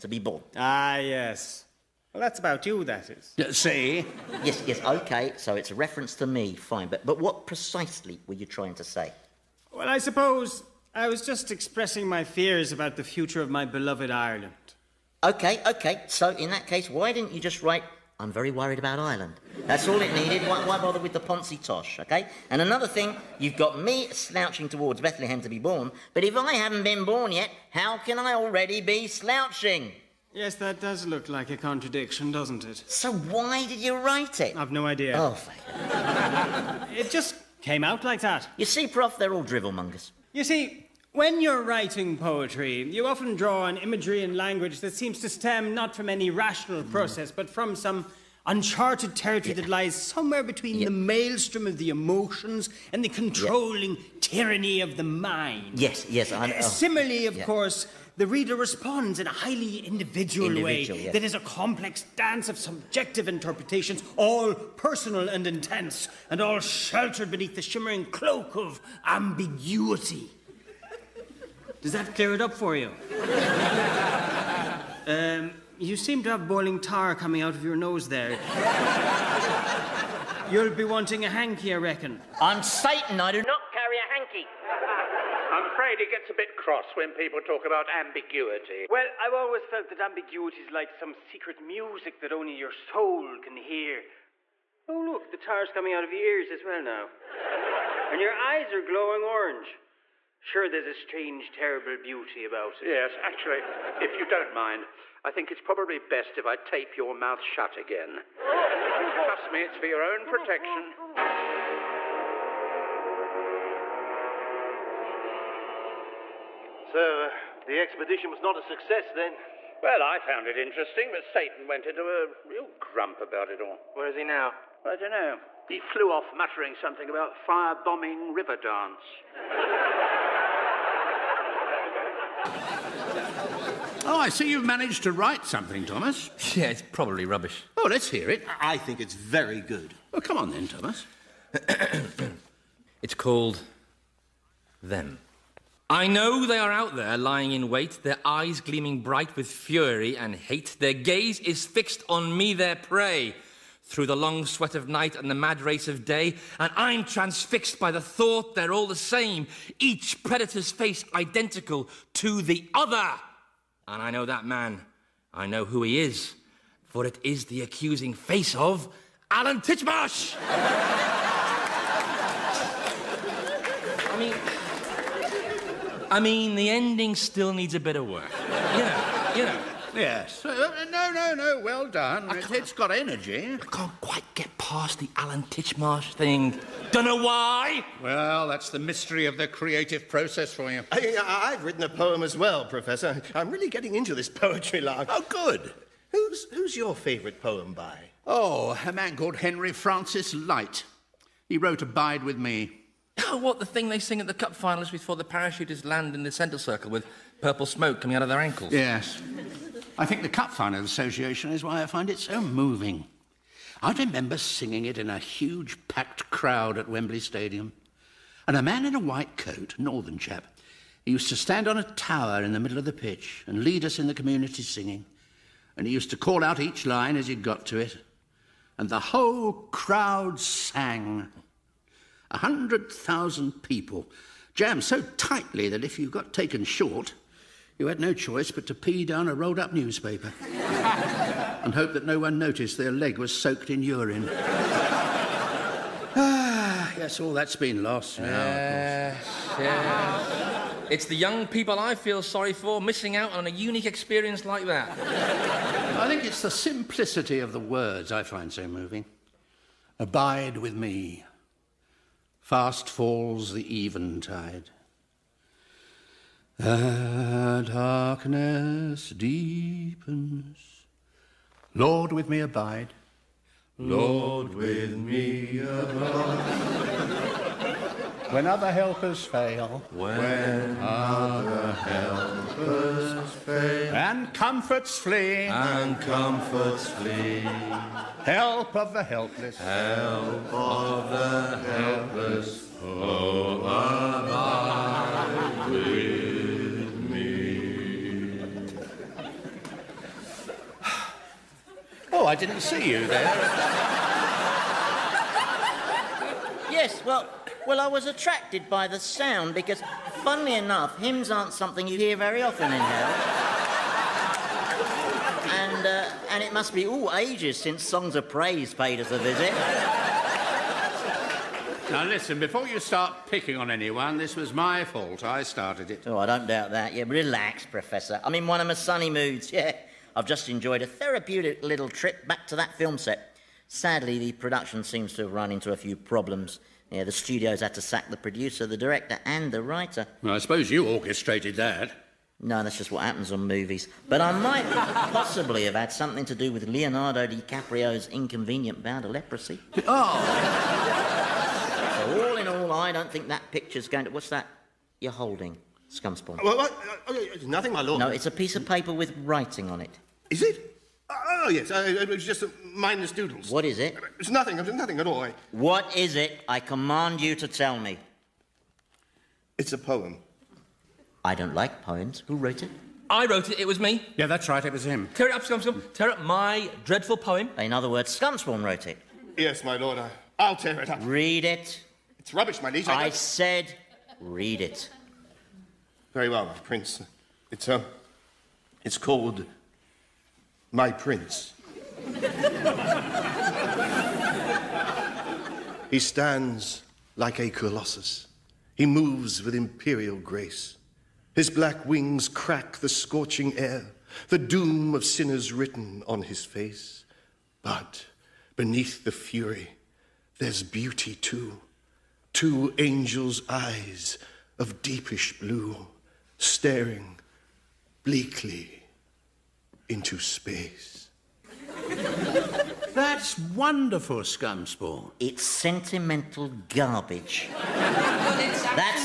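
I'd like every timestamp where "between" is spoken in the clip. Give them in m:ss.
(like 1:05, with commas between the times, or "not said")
0:50.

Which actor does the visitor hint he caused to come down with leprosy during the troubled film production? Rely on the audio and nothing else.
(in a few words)
Leonardo DiCaprio.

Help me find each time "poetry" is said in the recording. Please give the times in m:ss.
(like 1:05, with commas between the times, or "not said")
0:42, 3:14.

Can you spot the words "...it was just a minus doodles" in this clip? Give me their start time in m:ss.
6:01.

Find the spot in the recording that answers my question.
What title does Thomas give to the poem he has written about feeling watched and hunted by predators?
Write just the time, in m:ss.
2:24.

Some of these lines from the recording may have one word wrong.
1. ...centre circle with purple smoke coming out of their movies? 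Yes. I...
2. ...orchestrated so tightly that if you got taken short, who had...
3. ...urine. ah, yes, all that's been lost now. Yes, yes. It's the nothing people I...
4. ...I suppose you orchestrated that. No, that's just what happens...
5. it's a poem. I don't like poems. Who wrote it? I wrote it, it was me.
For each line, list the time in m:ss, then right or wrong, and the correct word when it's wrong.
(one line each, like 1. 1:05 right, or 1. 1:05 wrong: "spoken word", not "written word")
1. 3:26 wrong: "ankles", not "movies"
2. 3:54 wrong: "jammed", not "orchestrated"
3. 4:03 wrong: "young", not "nothing"
4. 5:40 right
5. 6:09 right.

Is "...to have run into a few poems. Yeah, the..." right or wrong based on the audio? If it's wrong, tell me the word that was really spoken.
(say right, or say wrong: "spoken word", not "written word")
wrong: "problems", not "poems".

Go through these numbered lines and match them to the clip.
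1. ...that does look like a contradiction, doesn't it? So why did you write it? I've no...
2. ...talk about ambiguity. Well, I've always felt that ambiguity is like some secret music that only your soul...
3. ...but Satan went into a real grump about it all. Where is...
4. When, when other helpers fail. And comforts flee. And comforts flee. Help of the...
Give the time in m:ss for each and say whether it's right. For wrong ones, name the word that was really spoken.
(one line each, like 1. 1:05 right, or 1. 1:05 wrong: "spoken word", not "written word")
1. 0:30 right
2. 1:27 right
3. 2:01 right
4. 4:39 right.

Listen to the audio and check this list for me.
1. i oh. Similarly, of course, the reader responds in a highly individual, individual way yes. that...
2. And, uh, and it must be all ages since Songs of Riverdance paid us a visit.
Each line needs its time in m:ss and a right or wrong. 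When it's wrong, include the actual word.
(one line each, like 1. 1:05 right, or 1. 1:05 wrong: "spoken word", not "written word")
1. 0:56 right
2. 5:15 wrong: "Praise", not "Riverdance".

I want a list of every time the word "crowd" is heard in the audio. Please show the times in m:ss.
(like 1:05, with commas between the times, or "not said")
3:36, 3:49.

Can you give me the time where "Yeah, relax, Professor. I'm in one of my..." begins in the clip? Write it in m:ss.
5:26.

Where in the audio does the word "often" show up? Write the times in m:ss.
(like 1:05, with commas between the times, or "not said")
0:43, 5:12.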